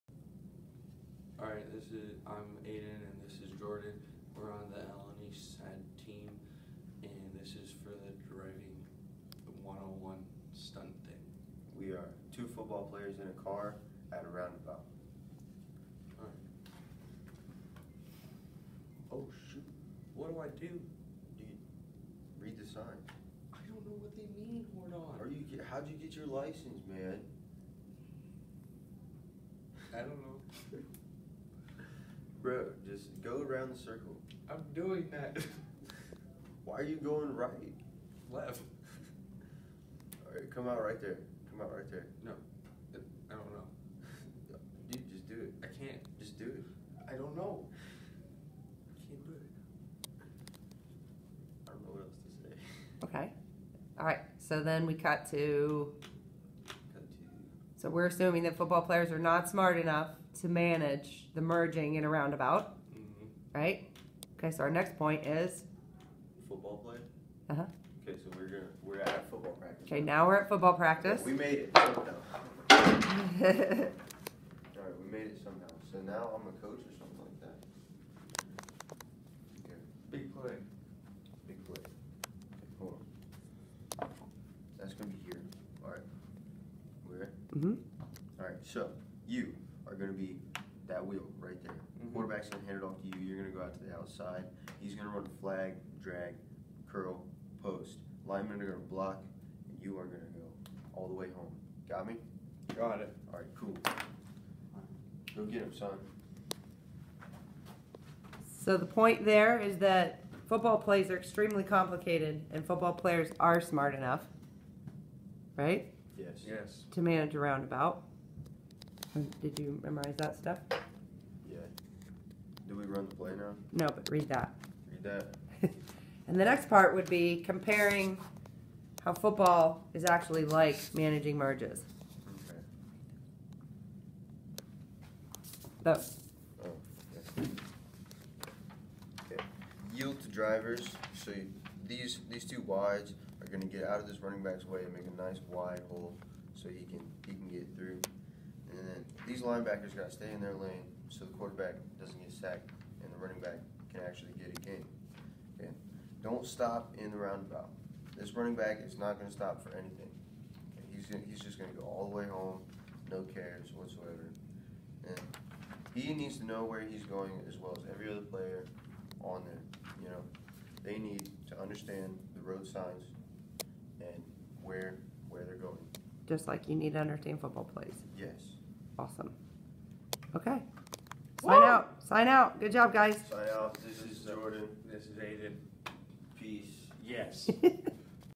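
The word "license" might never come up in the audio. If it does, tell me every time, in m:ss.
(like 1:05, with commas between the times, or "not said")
0:26.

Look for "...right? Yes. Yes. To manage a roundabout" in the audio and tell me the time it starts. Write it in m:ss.
1:55.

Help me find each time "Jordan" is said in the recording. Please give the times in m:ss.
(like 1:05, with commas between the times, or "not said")
0:03, 0:24, 3:04.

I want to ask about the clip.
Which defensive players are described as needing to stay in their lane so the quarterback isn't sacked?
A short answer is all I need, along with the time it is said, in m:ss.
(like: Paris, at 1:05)
Linebackers, at 2:29.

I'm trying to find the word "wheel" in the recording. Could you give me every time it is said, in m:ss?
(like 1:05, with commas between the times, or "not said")
1:31.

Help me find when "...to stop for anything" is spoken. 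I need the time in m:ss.
2:39.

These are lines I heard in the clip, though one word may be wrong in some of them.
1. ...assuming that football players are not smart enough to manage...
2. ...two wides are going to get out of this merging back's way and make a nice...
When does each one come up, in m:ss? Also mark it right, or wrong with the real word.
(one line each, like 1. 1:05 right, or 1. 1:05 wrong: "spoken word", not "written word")
1. 0:58 right
2. 2:22 wrong: "running", not "merging".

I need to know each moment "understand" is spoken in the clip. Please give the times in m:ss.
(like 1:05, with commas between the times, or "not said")
2:51, 2:56.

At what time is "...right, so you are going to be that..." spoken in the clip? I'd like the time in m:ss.
1:28.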